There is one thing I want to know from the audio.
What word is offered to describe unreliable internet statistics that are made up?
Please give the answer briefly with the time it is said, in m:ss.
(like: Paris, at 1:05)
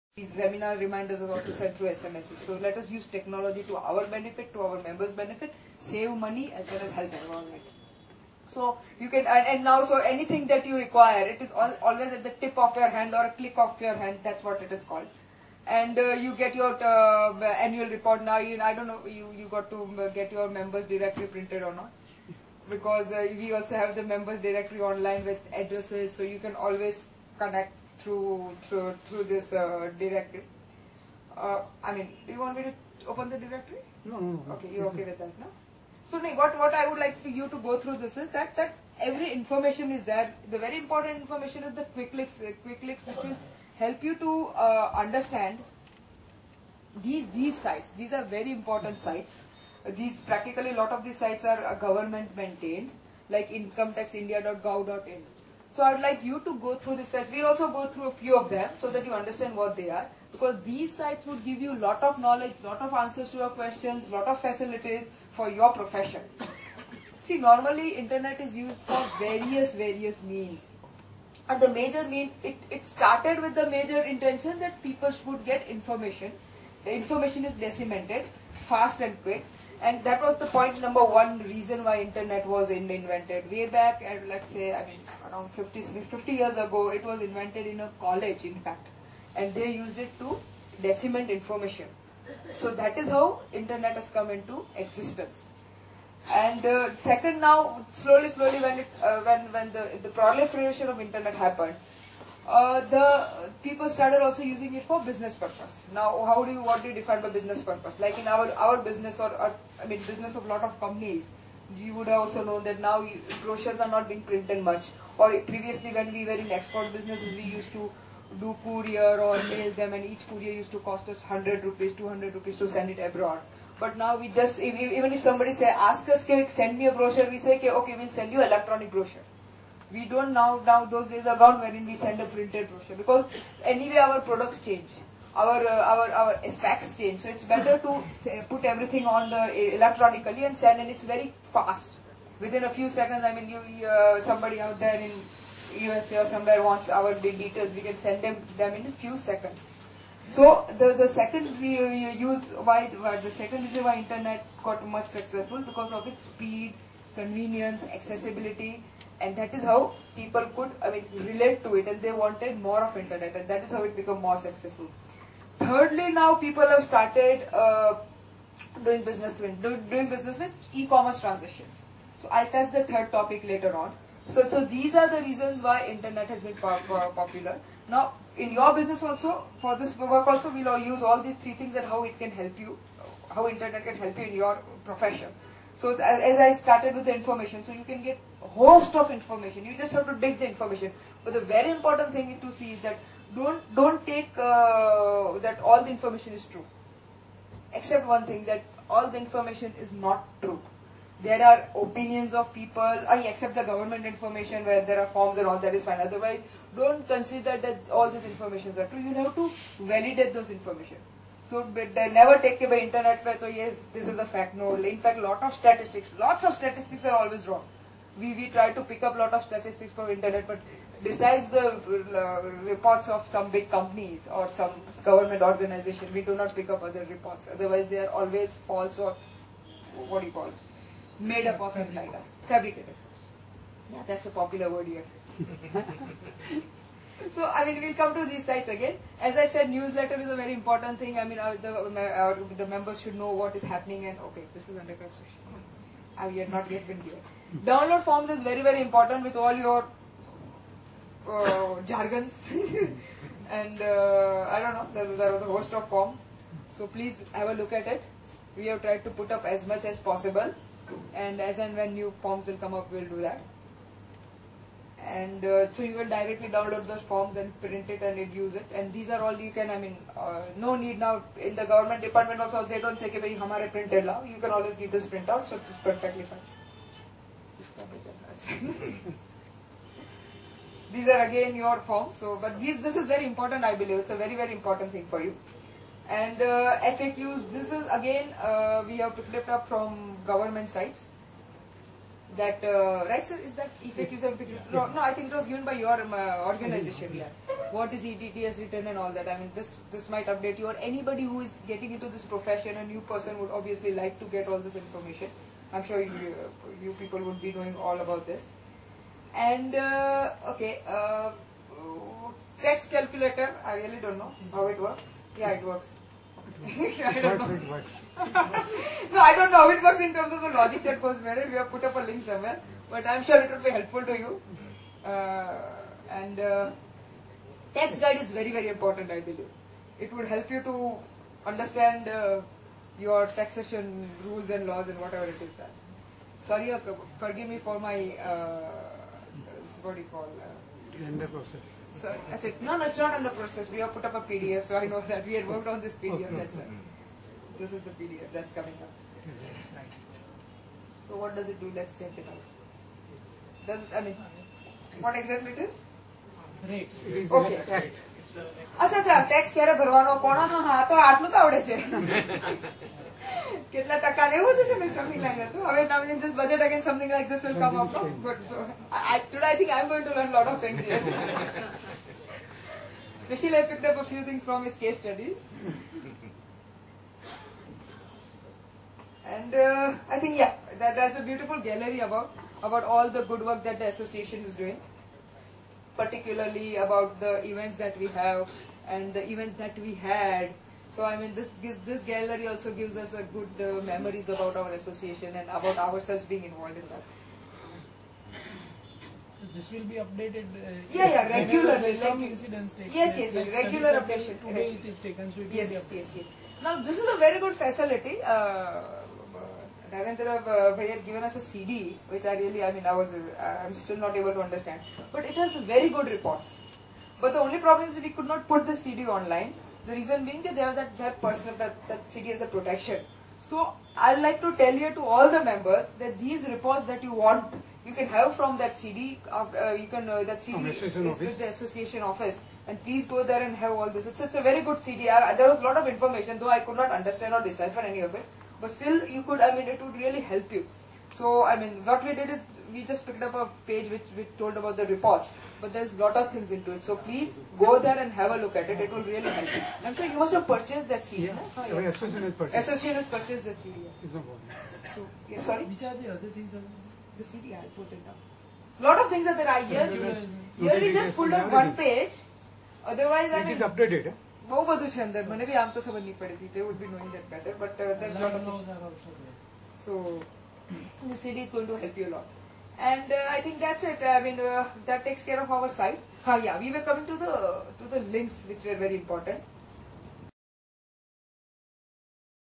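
Fabricated, at 3:52.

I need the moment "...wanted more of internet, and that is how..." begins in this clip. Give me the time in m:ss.
2:42.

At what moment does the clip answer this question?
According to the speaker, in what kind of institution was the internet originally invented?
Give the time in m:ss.
1:27.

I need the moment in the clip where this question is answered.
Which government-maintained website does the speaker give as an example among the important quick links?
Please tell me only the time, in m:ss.
0:53.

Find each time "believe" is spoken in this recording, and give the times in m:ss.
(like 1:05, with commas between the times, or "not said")
4:43, 5:29.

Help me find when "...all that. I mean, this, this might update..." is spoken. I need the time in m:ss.
4:58.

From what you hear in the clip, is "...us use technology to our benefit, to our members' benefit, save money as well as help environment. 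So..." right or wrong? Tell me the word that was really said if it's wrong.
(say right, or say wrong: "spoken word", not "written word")
right.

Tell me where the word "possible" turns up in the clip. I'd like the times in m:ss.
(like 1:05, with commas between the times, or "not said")
4:19.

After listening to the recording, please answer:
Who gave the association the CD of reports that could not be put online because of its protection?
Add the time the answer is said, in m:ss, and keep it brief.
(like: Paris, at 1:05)
Narendra, at 6:49.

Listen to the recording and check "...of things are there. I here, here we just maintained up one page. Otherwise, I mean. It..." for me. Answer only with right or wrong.
wrong.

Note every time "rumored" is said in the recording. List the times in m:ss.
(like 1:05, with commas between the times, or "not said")
not said.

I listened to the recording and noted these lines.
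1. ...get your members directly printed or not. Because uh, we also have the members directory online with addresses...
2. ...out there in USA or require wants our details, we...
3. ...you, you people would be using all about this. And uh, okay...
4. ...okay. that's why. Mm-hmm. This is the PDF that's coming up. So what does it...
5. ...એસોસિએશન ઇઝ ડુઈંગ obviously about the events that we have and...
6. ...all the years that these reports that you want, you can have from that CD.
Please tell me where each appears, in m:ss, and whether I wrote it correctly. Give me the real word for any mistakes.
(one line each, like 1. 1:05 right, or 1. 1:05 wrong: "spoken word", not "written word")
1. 0:20 right
2. 2:24 wrong: "somewhere", not "require"
3. 5:06 wrong: "knowing", not "using"
4. 5:46 right
5. 6:23 wrong: "particularly", not "obviously"
6. 7:05 wrong: "members", not "years".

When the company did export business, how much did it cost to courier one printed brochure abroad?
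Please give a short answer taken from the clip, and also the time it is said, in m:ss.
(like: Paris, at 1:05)
100 rupees, at 2:01.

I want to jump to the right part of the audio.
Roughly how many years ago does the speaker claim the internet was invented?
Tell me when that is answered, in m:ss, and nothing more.
1:26.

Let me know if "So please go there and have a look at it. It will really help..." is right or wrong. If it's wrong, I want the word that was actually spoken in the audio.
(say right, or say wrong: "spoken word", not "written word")
right.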